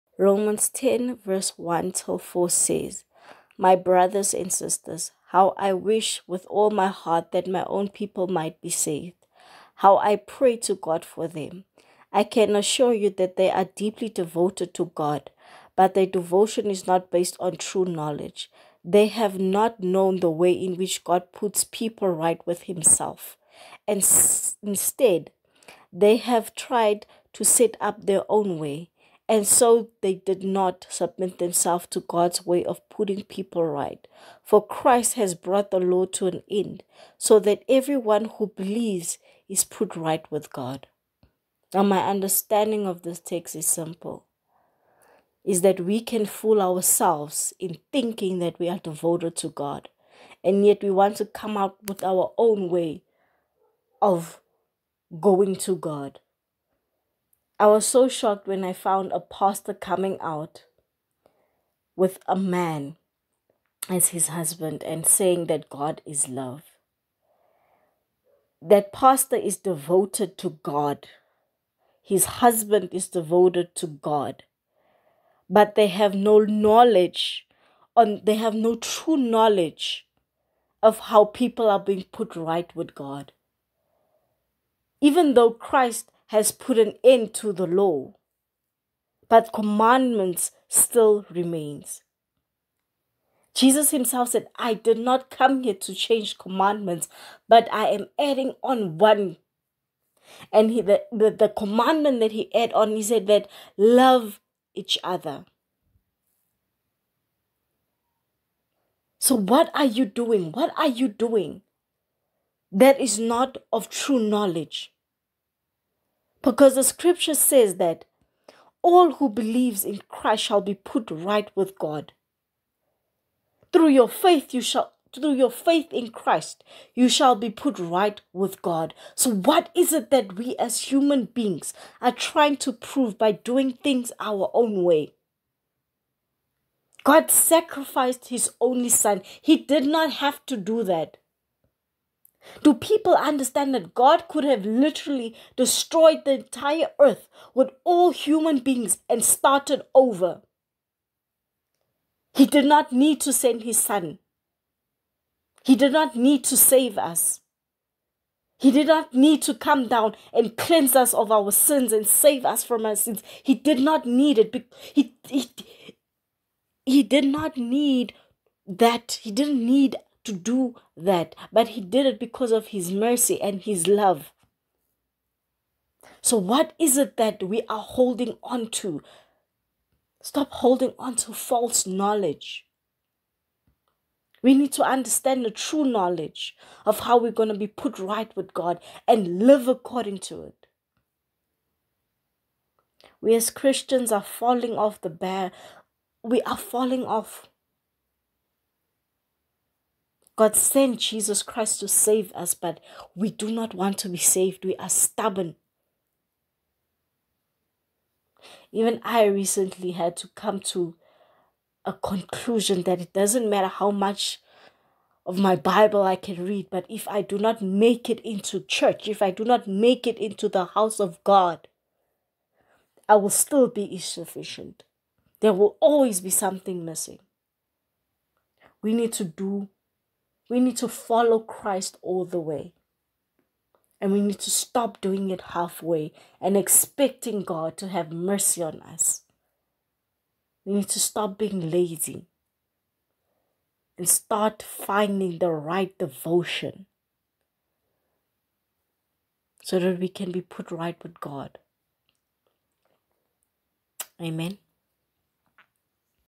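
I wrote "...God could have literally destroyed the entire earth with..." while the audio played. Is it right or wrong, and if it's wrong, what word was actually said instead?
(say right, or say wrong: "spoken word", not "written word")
right.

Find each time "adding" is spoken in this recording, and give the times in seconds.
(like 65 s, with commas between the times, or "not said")
98 s.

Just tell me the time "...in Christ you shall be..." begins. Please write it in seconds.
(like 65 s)
125 s.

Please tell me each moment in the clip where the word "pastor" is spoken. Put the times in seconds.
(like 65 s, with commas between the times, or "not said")
59 s, 68 s.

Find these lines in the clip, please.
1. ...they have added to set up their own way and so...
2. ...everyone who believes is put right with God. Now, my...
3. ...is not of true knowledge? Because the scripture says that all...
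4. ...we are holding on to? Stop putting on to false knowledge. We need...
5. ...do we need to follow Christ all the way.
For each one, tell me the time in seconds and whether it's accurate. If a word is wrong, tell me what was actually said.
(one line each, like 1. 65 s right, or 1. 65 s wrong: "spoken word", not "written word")
1. 25 s wrong: "tried", not "added"
2. 37 s right
3. 113 s right
4. 177 s wrong: "holding", not "putting"
5. 229 s right.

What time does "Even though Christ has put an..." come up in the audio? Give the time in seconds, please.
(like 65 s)
84 s.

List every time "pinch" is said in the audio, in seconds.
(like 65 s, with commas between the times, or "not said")
not said.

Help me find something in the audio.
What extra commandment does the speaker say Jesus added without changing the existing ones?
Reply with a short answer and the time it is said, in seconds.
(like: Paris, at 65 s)
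Love each other, at 103 s.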